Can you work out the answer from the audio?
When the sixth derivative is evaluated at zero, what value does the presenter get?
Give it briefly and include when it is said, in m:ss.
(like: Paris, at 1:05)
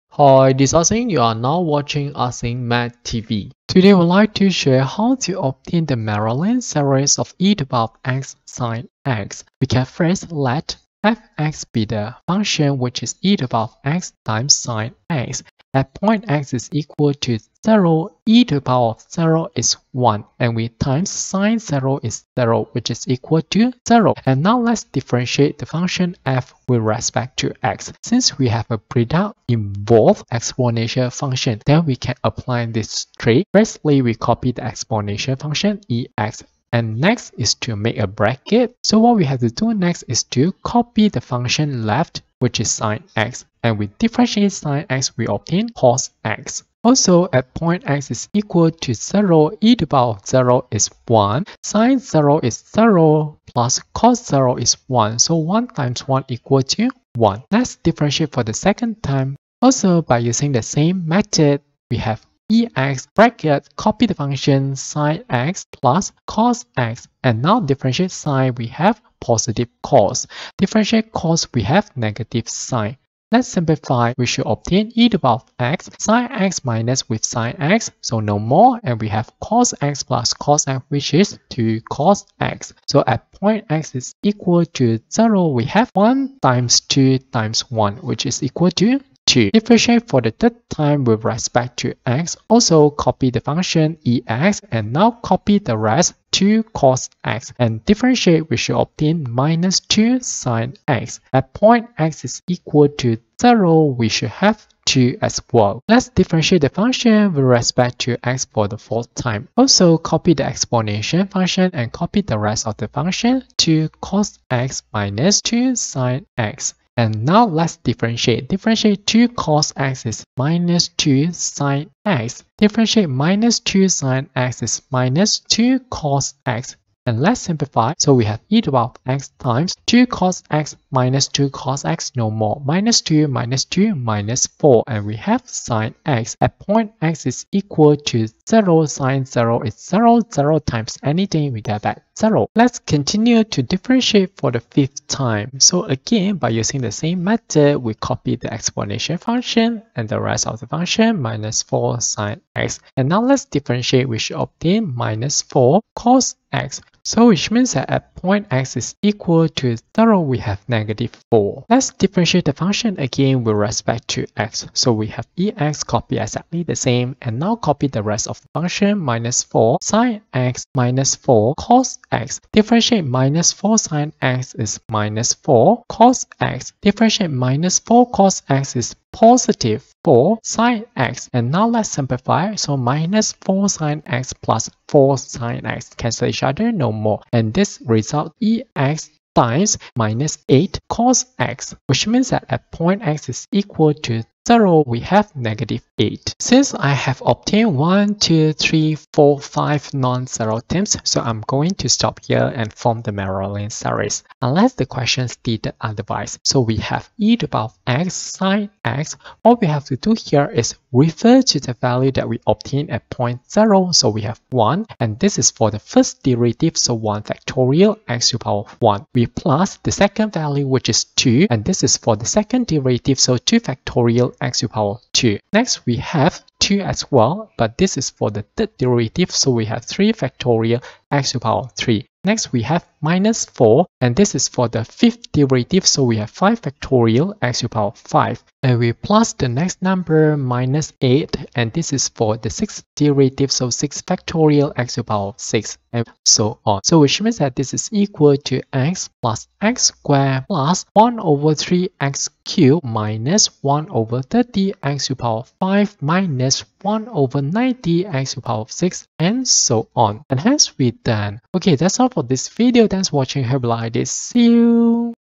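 -8, at 3:15.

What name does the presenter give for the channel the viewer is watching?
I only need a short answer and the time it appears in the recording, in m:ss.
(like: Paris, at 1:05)
Asing Math TV, at 0:02.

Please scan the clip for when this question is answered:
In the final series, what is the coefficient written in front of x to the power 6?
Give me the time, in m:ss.
4:16.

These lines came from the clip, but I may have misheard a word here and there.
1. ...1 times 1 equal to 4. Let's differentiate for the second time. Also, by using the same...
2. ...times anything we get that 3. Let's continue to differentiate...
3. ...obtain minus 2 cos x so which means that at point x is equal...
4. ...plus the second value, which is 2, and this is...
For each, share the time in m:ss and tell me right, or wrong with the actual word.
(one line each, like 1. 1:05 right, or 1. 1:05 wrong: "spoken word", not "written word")
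1. 0:55 wrong: "1", not "4"
2. 2:20 wrong: "0", not "3"
3. 2:34 wrong: "4", not "2"
4. 3:39 right.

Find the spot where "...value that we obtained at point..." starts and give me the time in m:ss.
3:31.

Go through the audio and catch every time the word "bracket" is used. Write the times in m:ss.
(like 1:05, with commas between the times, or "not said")
0:38, 1:03.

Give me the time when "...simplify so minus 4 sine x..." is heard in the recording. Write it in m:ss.
3:01.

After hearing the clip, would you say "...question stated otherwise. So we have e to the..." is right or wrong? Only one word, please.
right.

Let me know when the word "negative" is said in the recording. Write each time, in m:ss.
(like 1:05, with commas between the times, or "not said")
1:11, 2:40, 3:15.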